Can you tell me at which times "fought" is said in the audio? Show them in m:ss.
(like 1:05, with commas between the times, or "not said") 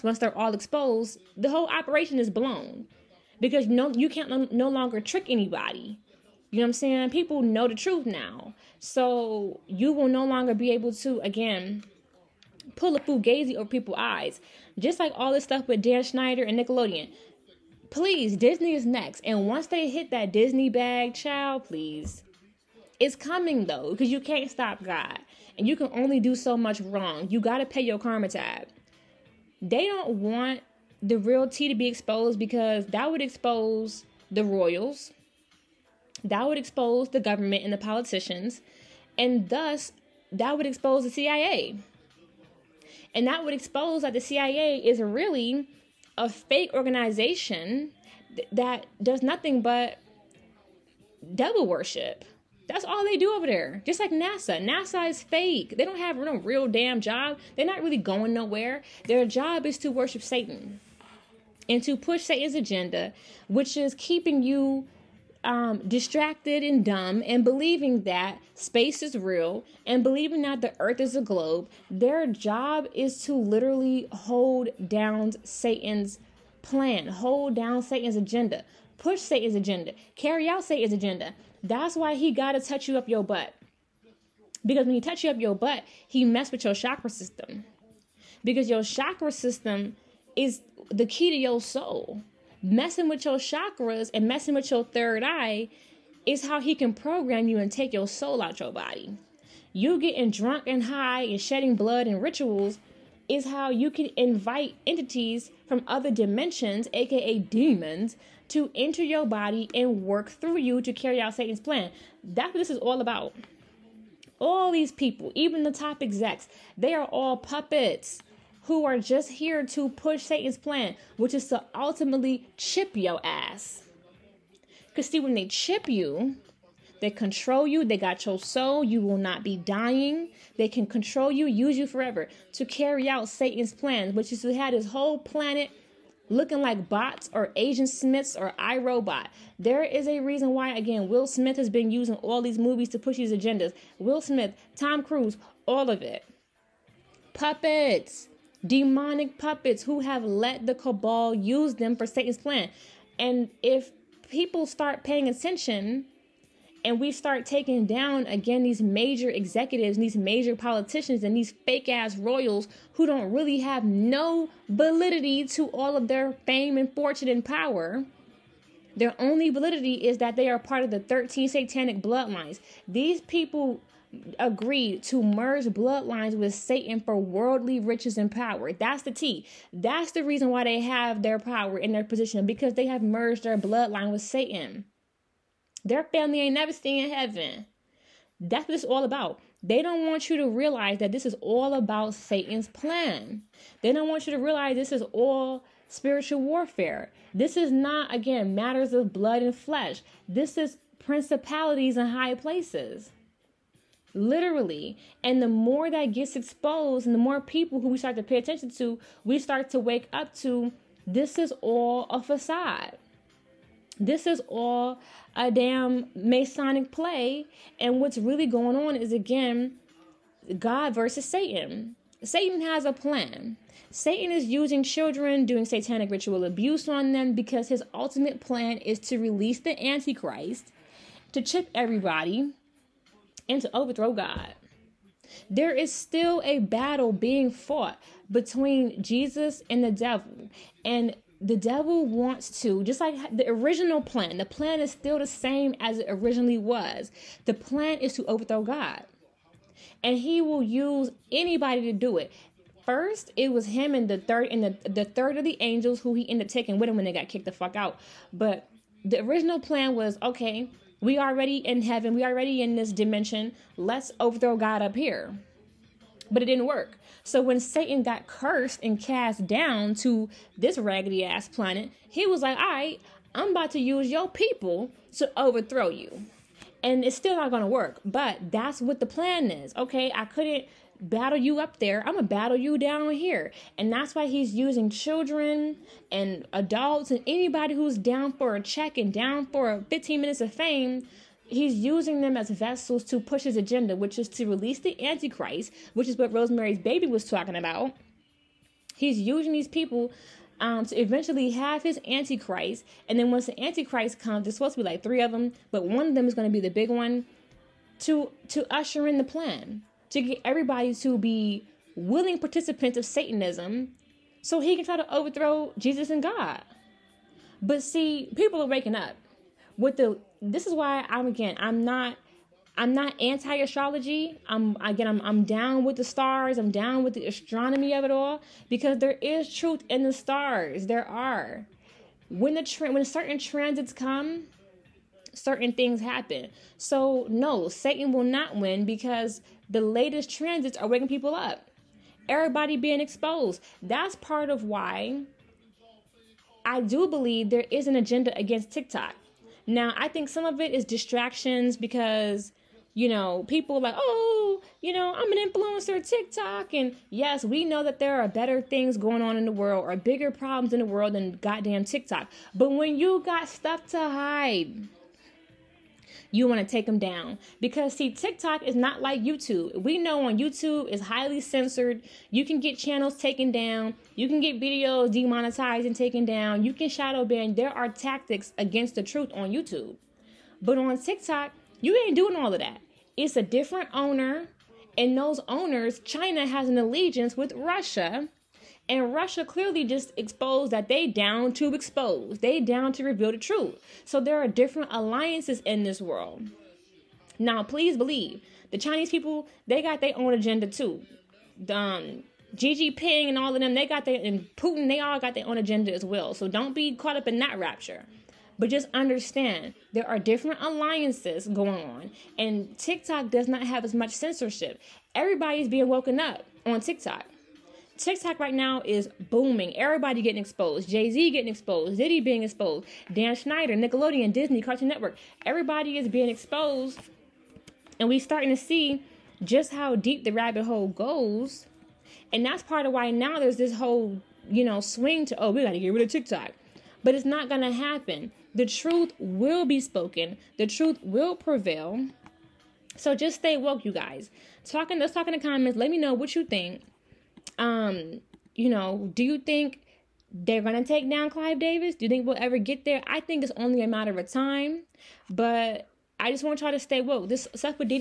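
3:57.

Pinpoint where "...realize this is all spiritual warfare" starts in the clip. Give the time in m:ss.
3:14.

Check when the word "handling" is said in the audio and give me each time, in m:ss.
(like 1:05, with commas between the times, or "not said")
not said.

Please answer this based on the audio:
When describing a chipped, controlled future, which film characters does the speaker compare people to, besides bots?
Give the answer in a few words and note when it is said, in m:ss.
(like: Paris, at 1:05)
Agent Smiths, at 2:17.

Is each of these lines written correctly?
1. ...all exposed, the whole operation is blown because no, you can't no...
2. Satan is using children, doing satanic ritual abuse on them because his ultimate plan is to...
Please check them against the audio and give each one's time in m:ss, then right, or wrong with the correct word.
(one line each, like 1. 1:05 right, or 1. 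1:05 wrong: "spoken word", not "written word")
1. 0:00 right
2. 3:43 right.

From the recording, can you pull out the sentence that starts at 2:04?
Because, see, when they chip you, they control you.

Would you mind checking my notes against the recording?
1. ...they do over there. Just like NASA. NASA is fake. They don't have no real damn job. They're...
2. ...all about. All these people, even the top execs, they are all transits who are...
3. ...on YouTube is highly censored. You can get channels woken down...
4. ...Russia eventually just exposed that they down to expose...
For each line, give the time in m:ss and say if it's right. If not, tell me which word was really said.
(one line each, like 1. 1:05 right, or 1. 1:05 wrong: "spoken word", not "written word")
1. 0:53 right
2. 1:52 wrong: "puppets", not "transits"
3. 6:10 wrong: "taken", not "woken"
4. 6:29 wrong: "clearly", not "eventually".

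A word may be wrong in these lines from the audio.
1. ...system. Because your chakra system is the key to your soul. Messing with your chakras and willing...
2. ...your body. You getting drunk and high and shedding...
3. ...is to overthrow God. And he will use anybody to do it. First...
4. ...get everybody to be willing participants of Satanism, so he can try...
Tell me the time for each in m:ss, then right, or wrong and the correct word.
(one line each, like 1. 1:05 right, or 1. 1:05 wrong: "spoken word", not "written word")
1. 1:27 wrong: "messing", not "willing"
2. 1:38 right
3. 4:07 right
4. 5:10 right.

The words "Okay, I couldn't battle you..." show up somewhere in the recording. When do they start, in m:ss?
4:39.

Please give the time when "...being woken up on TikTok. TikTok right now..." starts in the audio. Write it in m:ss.
6:55.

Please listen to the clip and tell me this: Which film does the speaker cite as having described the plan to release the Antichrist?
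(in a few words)
Rosemary's Baby.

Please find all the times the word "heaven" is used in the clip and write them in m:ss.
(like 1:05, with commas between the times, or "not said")
3:07, 4:21.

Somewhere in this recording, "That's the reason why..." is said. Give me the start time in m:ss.
2:59.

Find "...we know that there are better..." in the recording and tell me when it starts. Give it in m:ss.
5:57.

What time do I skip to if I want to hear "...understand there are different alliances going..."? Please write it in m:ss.
6:48.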